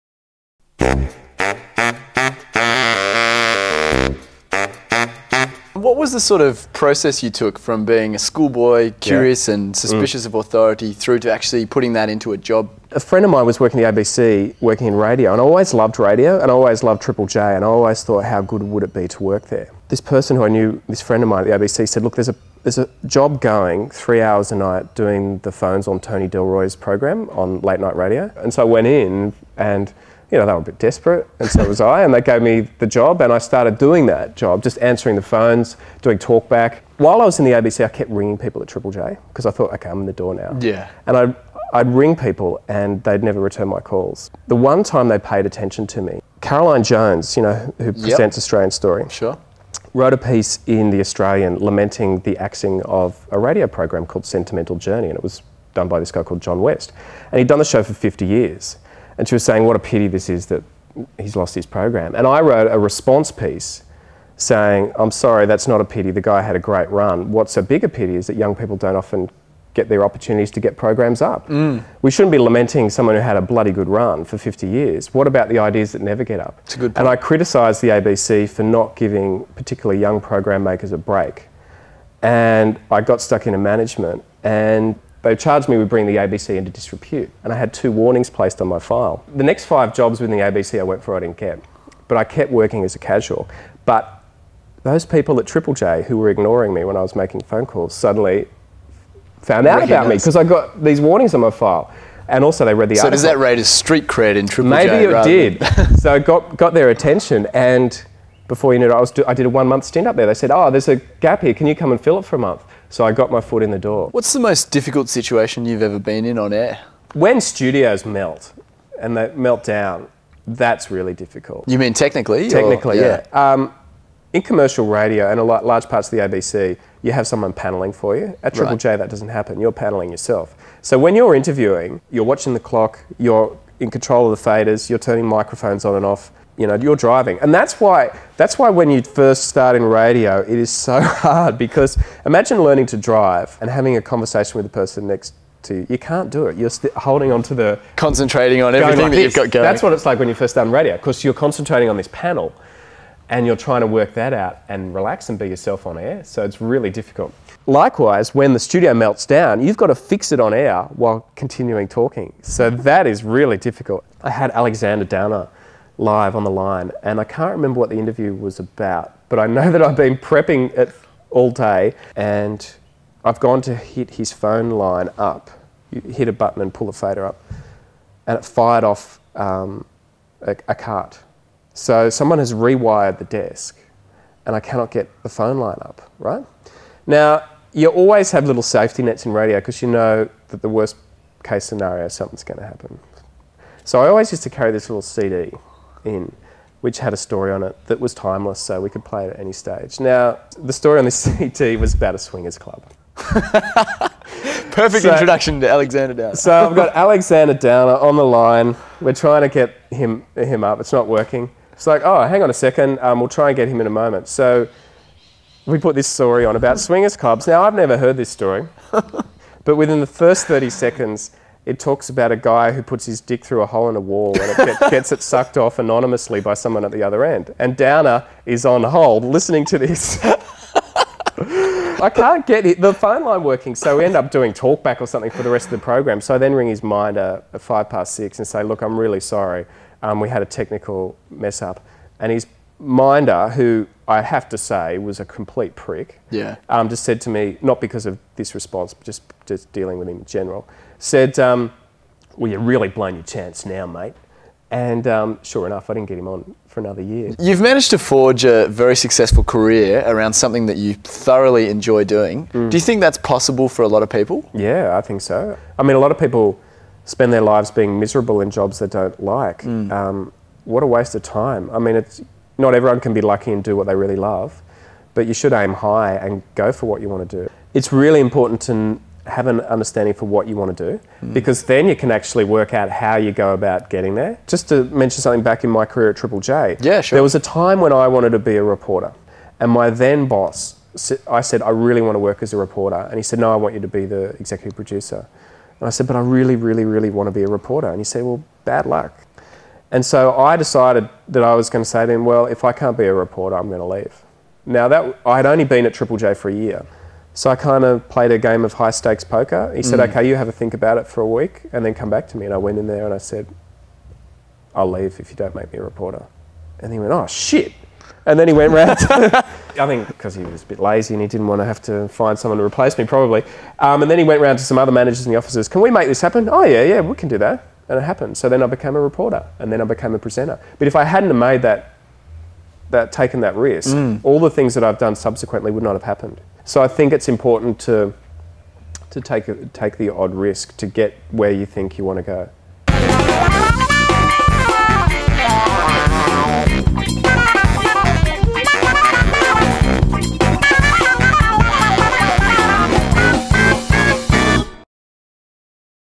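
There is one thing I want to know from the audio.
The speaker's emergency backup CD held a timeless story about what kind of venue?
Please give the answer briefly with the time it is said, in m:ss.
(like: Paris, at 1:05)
A swingers club, at 3:22.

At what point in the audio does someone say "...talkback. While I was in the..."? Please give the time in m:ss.
0:36.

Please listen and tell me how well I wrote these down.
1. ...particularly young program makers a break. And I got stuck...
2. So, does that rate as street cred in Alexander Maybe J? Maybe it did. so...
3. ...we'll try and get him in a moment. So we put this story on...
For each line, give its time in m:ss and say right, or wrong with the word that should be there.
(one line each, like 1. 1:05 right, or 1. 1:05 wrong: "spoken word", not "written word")
1. 1:19 right
2. 1:43 wrong: "Triple", not "Alexander"
3. 3:33 right.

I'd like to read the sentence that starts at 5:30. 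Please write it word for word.
But if I hadn't made that, that taken that risk, mm.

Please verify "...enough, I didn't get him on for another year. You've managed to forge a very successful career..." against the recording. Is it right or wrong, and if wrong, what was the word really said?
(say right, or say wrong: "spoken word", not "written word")
right.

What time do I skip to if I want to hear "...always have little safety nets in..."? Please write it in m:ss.
3:07.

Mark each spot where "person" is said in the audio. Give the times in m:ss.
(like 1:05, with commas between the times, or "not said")
0:20, 2:24.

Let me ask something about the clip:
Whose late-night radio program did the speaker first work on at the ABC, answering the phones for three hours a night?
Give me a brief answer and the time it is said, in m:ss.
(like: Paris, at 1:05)
Tony Delroy, at 0:25.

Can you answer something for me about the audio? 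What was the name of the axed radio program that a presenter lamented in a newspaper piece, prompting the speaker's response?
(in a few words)
Sentimental Journey.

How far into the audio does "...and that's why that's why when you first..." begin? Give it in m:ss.
2:17.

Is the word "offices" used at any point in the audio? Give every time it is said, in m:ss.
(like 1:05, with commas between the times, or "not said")
5:25.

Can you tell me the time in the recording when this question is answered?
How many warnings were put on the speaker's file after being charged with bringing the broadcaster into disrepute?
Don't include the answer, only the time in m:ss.
1:27.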